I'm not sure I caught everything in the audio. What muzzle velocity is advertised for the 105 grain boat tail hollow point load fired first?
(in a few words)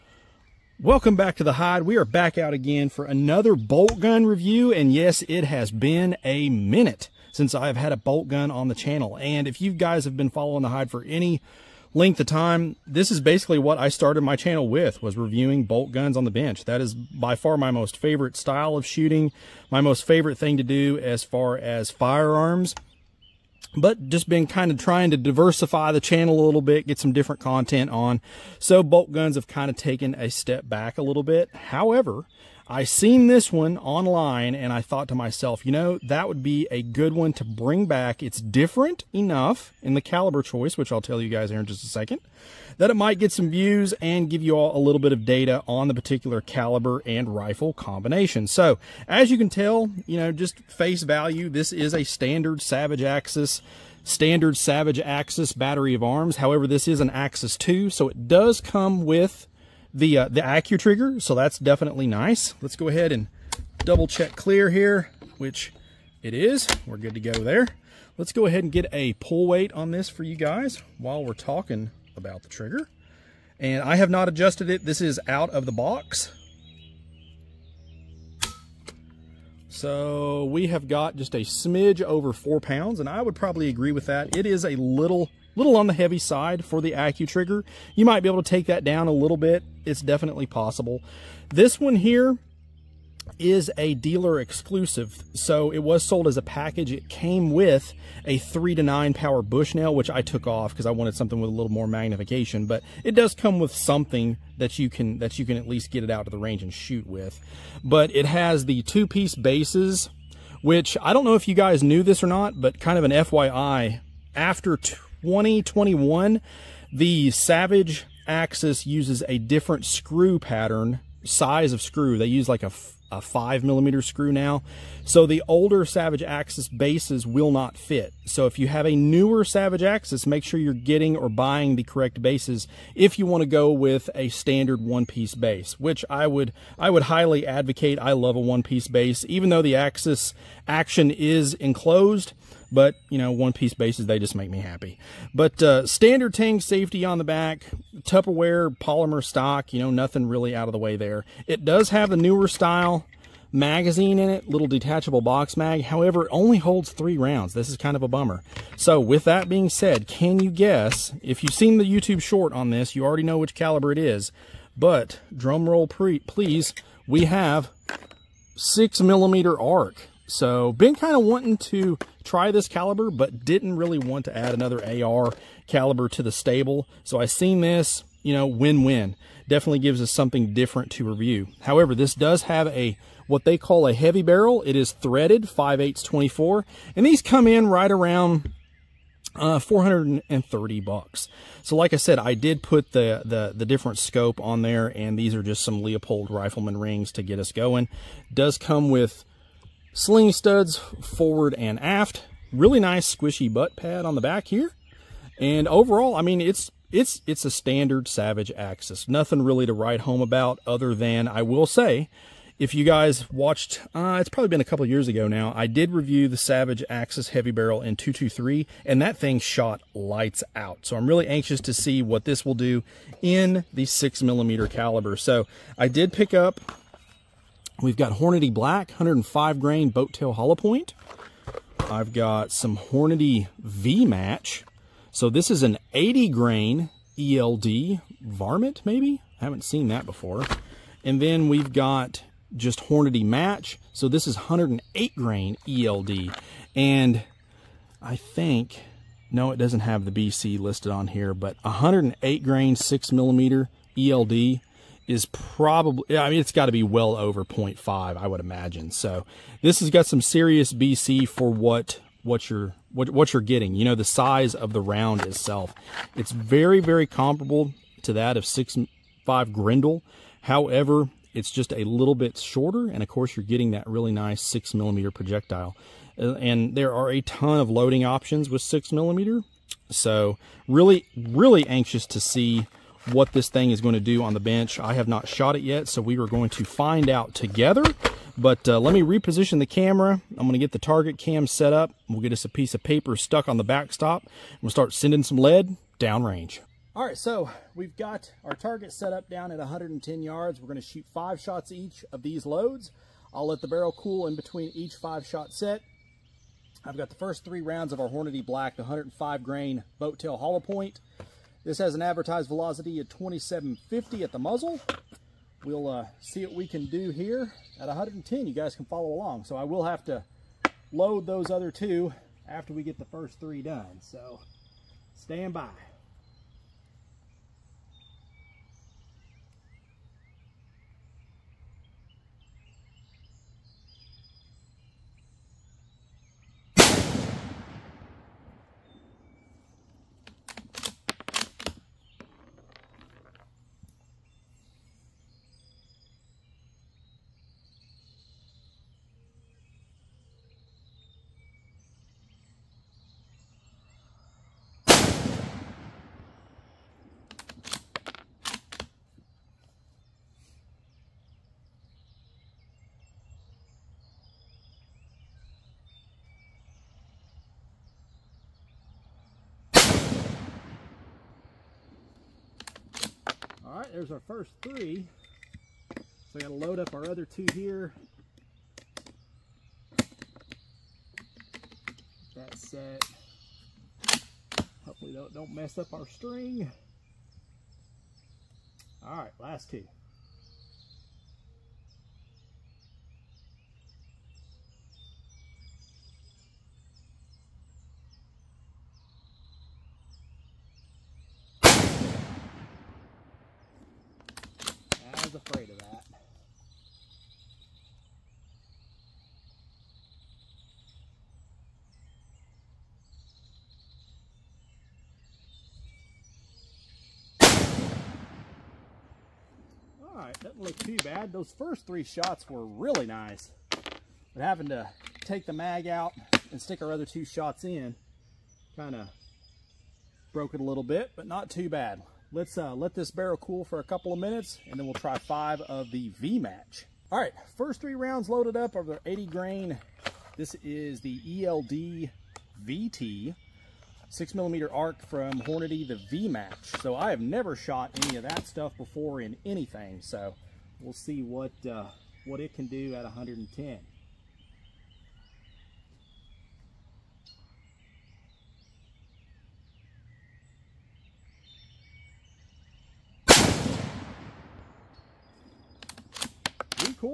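2750.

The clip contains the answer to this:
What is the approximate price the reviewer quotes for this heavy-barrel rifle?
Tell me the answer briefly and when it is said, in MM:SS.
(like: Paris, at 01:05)
$430, at 03:09.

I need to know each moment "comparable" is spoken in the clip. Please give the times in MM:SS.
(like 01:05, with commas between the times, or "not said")
04:27.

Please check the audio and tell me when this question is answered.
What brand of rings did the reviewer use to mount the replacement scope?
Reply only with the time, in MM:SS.
03:15.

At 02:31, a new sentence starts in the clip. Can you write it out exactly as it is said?
It does have the newer style magazine in it, little detachable box mag.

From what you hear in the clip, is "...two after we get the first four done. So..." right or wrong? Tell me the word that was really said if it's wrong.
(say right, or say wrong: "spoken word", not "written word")
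wrong: "three", not "four".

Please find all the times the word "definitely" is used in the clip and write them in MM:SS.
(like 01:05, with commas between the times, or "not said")
01:01, 01:30, 02:59.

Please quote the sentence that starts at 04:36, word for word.
Uh, and there are a ton of loading options with 6 millimeter.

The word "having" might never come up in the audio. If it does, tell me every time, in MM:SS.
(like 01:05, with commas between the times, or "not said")
07:04.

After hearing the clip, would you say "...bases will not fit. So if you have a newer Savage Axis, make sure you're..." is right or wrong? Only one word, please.
right.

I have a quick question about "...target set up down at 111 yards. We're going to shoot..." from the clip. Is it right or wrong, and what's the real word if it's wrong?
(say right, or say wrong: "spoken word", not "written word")
wrong: "110", not "111".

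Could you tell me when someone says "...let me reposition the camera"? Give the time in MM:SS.
04:48.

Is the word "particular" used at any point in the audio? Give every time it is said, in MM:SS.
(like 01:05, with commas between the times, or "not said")
00:45.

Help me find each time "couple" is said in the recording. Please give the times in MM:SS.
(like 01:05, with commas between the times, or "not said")
03:34, 07:13.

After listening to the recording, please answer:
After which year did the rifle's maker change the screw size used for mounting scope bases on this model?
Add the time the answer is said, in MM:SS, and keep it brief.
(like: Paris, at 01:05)
2021, at 01:55.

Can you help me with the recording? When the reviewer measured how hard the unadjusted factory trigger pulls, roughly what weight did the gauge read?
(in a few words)
just over 4 pounds.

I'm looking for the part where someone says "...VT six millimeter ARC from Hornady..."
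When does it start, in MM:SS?
07:22.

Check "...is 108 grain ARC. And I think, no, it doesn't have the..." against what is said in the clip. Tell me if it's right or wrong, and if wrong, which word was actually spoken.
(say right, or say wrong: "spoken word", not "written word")
wrong: "ELD", not "ARC".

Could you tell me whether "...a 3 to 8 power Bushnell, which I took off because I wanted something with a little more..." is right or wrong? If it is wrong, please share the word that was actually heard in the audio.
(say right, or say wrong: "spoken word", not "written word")
wrong: "9", not "8".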